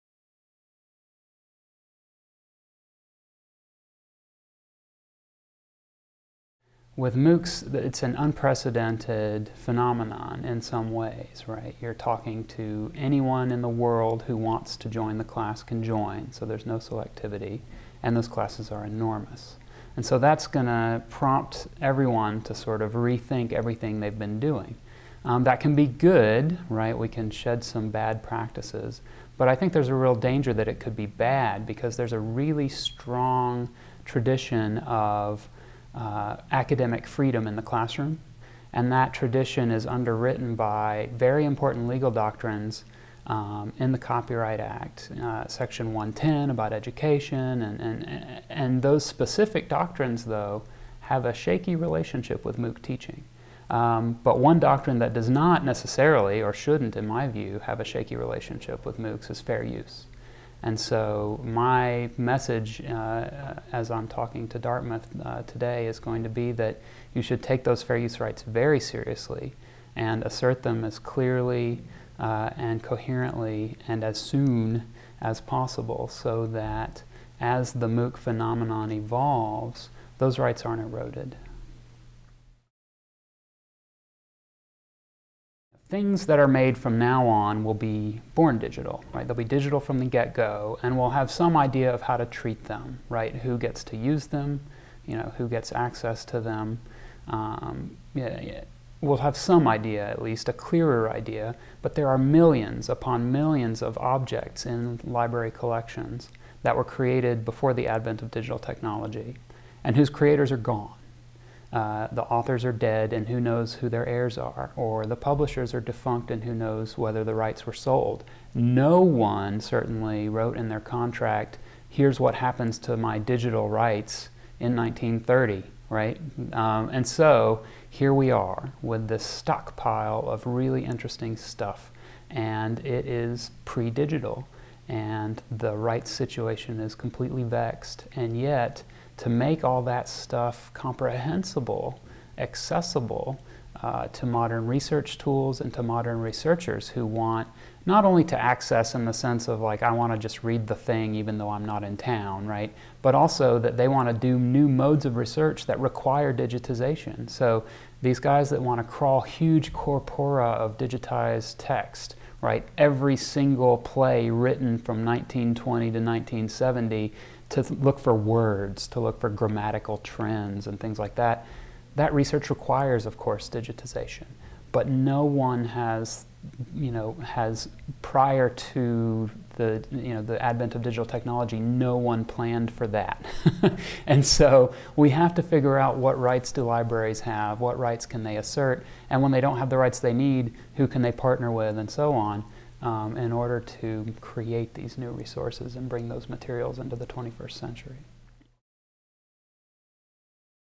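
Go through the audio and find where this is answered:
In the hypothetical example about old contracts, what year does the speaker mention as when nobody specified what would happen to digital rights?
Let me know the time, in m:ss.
2:04.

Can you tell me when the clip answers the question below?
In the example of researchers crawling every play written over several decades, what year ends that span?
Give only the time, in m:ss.
2:45.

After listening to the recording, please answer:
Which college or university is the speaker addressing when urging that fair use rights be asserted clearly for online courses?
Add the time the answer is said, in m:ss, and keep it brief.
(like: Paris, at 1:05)
Dartmouth, at 1:04.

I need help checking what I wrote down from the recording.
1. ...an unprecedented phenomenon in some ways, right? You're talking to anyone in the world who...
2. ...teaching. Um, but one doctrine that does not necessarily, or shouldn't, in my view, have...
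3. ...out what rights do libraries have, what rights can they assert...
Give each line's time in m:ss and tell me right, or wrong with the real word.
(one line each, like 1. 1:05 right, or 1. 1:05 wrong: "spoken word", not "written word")
1. 0:08 right
2. 0:52 right
3. 3:05 right.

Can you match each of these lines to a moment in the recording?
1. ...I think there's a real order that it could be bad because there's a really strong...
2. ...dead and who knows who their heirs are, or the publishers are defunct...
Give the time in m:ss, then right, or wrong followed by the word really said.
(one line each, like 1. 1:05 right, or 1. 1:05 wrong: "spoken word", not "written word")
1. 0:29 wrong: "danger", not "order"
2. 1:52 right.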